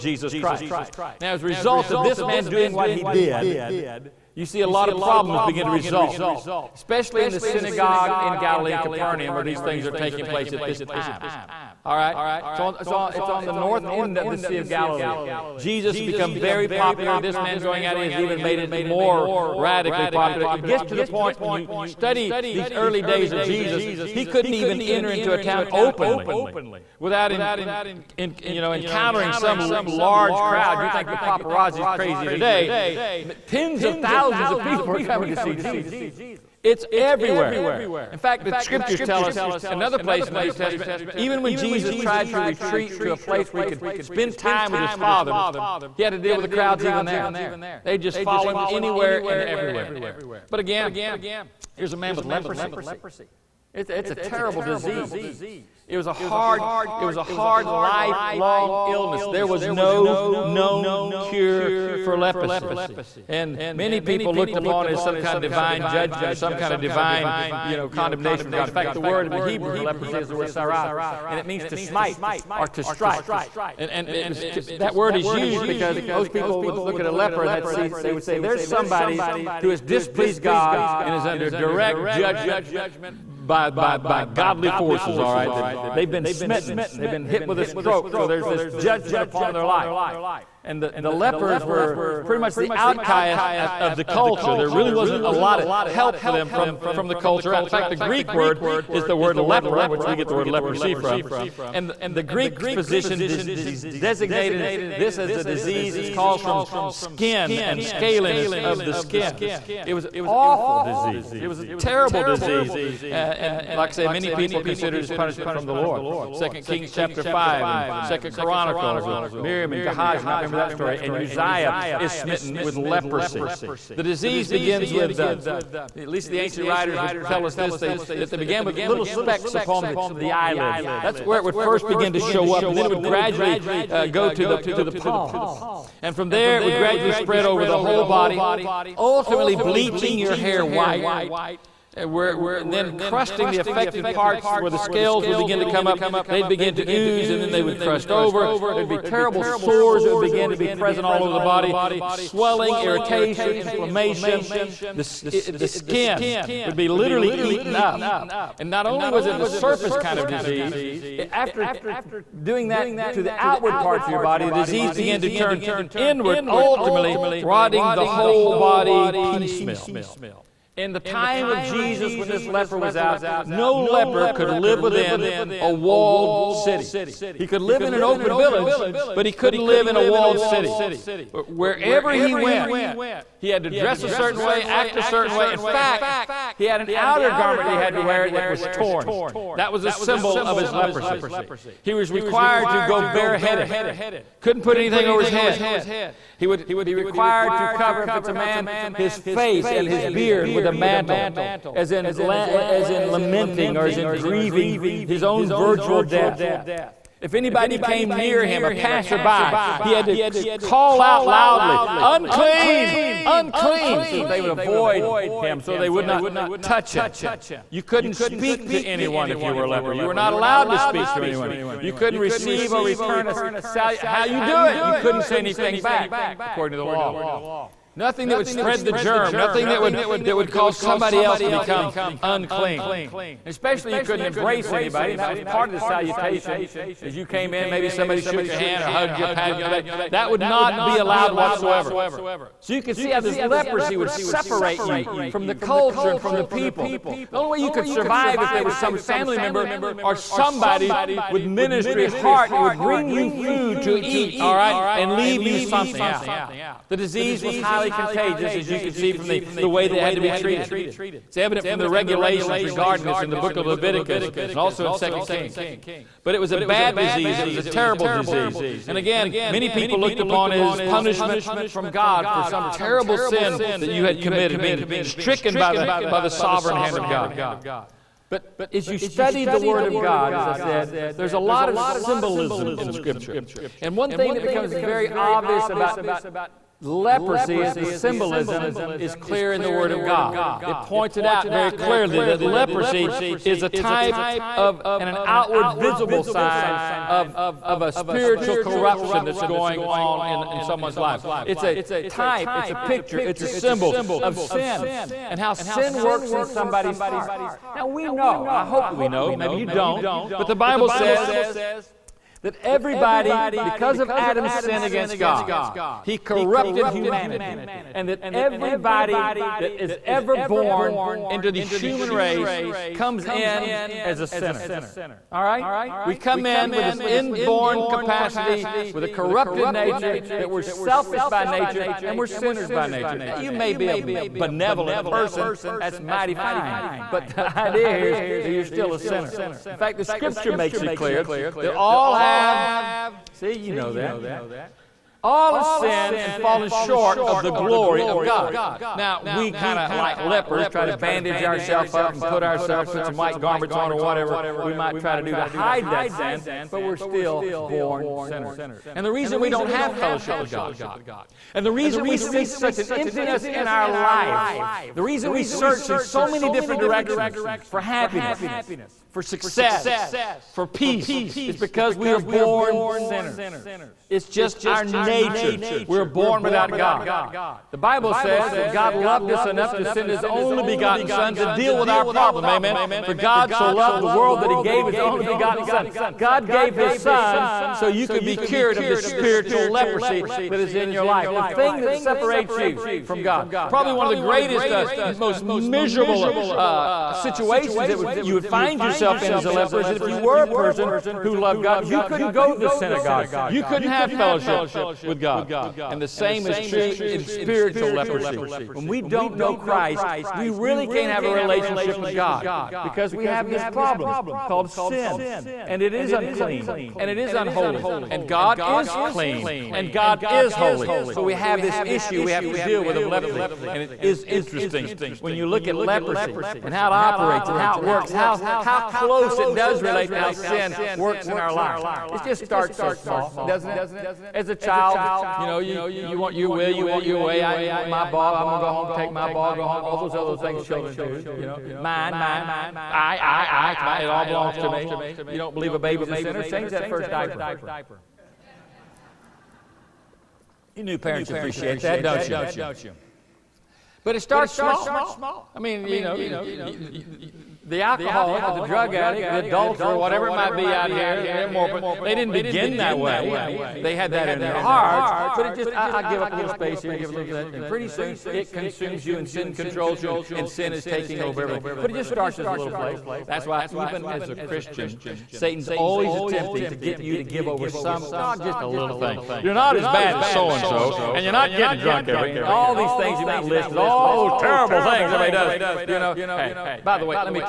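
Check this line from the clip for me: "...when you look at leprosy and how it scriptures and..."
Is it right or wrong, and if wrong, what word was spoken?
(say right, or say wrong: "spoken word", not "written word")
wrong: "operates", not "scriptures".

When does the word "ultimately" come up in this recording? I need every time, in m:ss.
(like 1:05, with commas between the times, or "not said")
2:18, 2:46.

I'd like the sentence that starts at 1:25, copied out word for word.
That they've been smitten, they've been hit with a stroke, so there's this judgment upon their life.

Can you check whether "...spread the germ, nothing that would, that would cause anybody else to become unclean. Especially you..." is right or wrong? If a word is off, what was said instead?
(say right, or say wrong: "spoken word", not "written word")
wrong: "somebody", not "anybody".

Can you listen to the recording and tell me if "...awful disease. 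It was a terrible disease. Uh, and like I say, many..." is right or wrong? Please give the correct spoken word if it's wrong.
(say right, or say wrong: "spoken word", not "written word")
right.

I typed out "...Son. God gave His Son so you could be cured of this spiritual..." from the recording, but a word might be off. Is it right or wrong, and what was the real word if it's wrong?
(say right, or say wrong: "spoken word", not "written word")
right.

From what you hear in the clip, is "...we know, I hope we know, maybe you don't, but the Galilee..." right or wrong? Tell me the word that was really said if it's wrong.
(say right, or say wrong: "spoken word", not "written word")
wrong: "Bible", not "Galilee".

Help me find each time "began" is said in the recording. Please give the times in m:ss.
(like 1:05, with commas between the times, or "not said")
2:08, 2:44.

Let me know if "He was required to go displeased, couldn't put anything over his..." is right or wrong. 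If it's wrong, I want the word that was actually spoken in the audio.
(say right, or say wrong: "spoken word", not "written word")
wrong: "bareheaded", not "displeased".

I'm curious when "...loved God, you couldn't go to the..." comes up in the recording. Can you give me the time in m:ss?
6:41.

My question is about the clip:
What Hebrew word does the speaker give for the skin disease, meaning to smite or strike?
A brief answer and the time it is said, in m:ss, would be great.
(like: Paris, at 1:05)
sarath, at 1:10.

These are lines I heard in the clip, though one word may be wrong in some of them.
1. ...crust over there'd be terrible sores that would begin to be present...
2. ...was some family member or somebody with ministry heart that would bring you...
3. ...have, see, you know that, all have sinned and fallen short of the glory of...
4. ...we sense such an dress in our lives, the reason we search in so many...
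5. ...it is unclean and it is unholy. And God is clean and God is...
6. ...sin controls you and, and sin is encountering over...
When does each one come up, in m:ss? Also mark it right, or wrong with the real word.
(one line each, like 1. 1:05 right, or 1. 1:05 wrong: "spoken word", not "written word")
1. 2:27 right
2. 4:08 right
3. 5:42 right
4. 6:02 wrong: "emptiness", not "dress"
5. 6:55 right
6. 7:49 wrong: "taking", not "encountering".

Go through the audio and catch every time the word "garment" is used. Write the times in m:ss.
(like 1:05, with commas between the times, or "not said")
3:07, 5:53.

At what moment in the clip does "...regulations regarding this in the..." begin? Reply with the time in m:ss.
4:21.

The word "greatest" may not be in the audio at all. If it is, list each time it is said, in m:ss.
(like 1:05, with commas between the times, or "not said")
6:34.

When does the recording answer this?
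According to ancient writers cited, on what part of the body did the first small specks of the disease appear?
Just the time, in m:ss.
2:10.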